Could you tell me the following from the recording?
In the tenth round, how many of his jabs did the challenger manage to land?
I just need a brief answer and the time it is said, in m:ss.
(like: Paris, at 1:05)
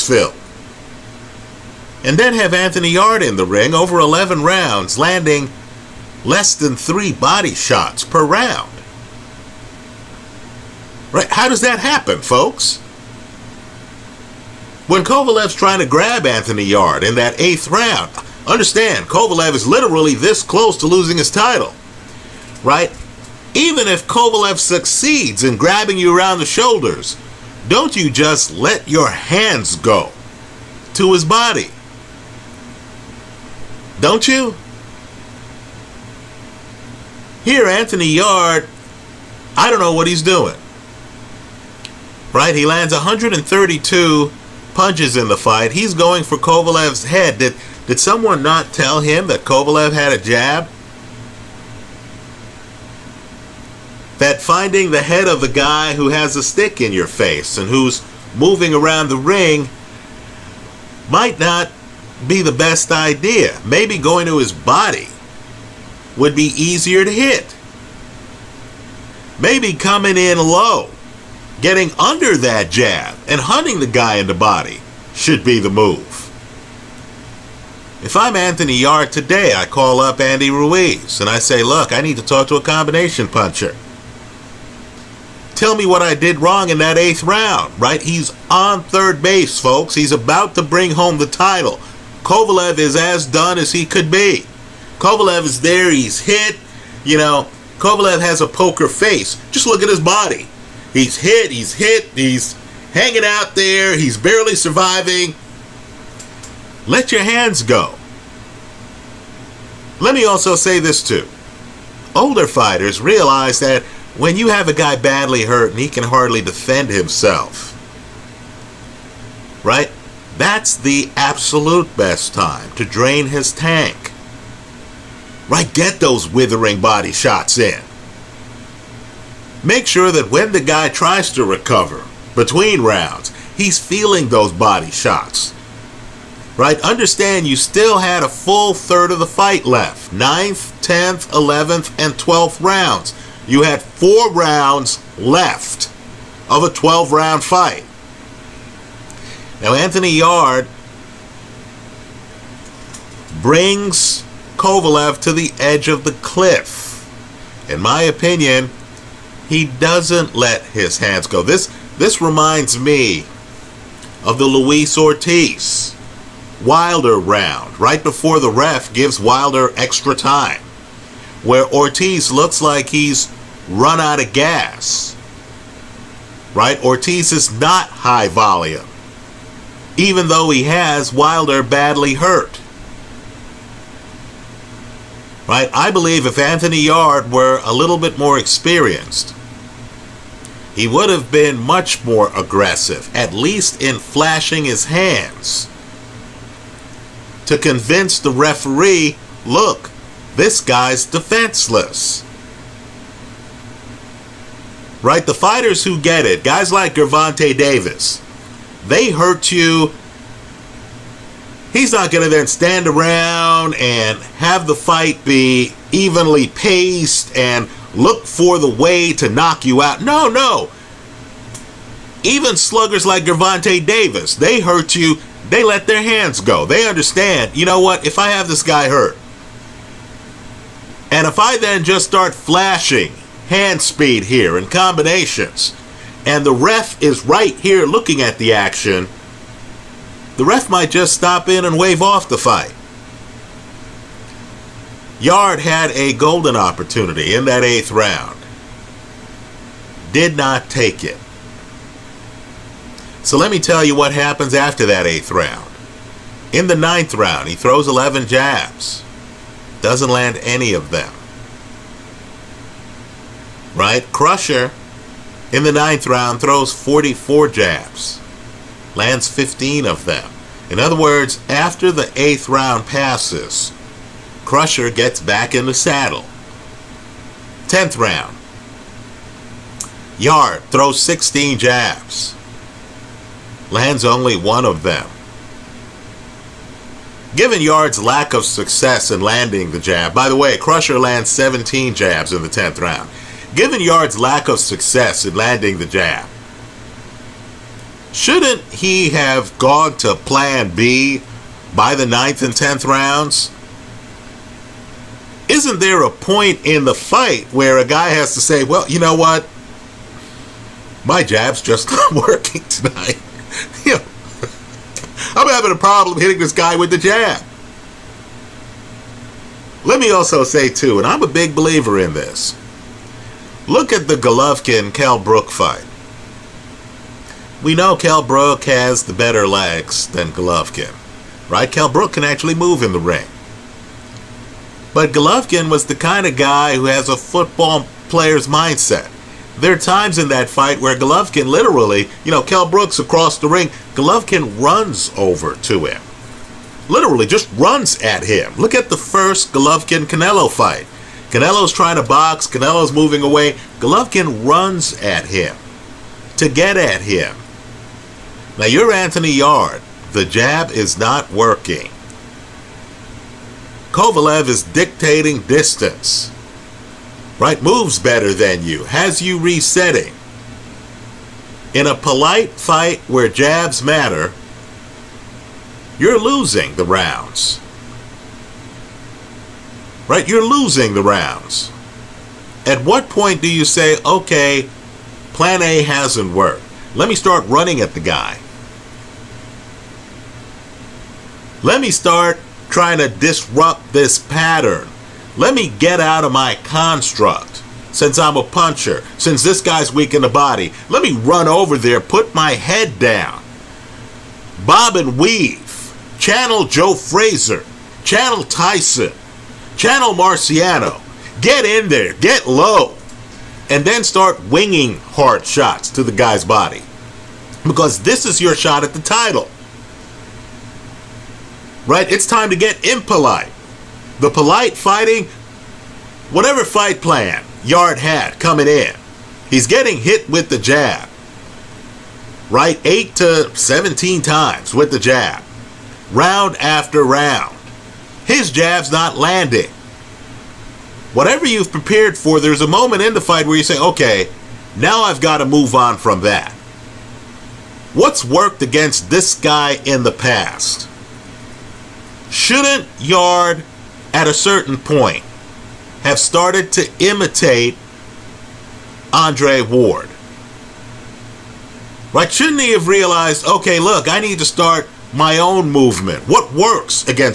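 1, at 4:44.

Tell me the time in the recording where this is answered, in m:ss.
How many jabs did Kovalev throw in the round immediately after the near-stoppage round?
4:26.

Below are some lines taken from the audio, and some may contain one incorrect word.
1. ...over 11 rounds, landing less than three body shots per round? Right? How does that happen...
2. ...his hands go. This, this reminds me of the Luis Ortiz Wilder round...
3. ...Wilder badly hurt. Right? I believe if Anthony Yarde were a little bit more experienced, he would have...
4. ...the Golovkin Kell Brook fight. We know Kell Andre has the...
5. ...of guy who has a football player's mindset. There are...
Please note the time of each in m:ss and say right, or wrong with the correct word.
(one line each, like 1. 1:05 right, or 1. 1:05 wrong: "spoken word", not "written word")
1. 0:03 right
2. 2:40 right
3. 3:01 right
4. 5:24 wrong: "Brook", not "Andre"
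5. 5:36 right.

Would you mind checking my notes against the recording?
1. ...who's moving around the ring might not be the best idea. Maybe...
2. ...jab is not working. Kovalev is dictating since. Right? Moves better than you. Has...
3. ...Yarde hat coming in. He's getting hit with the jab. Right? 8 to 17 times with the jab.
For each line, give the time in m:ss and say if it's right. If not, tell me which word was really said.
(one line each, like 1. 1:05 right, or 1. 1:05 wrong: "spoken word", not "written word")
1. 0:57 right
2. 6:00 wrong: "distance", not "since"
3. 7:07 right.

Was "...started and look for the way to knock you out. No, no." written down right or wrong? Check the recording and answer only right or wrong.
wrong.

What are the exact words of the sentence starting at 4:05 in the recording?
Yarde had a golden opportunity in that eighth round.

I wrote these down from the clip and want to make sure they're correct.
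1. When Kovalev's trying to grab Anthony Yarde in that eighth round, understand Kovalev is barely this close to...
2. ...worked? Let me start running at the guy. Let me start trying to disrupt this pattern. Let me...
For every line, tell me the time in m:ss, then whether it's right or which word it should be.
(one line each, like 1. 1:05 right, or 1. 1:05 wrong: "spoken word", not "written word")
1. 0:14 wrong: "literally", not "barely"
2. 6:26 right.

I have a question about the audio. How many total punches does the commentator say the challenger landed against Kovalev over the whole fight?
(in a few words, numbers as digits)
132.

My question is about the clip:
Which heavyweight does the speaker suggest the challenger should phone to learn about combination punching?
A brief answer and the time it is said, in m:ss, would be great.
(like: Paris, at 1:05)
Andy Ruiz, at 1:20.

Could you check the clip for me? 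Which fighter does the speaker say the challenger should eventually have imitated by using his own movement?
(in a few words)
Andre Ward.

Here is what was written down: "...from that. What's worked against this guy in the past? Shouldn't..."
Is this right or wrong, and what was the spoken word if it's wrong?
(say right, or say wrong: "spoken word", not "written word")
right.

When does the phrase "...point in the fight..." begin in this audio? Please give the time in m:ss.
5:06.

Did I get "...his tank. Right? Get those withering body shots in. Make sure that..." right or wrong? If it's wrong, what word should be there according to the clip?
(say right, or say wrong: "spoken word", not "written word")
right.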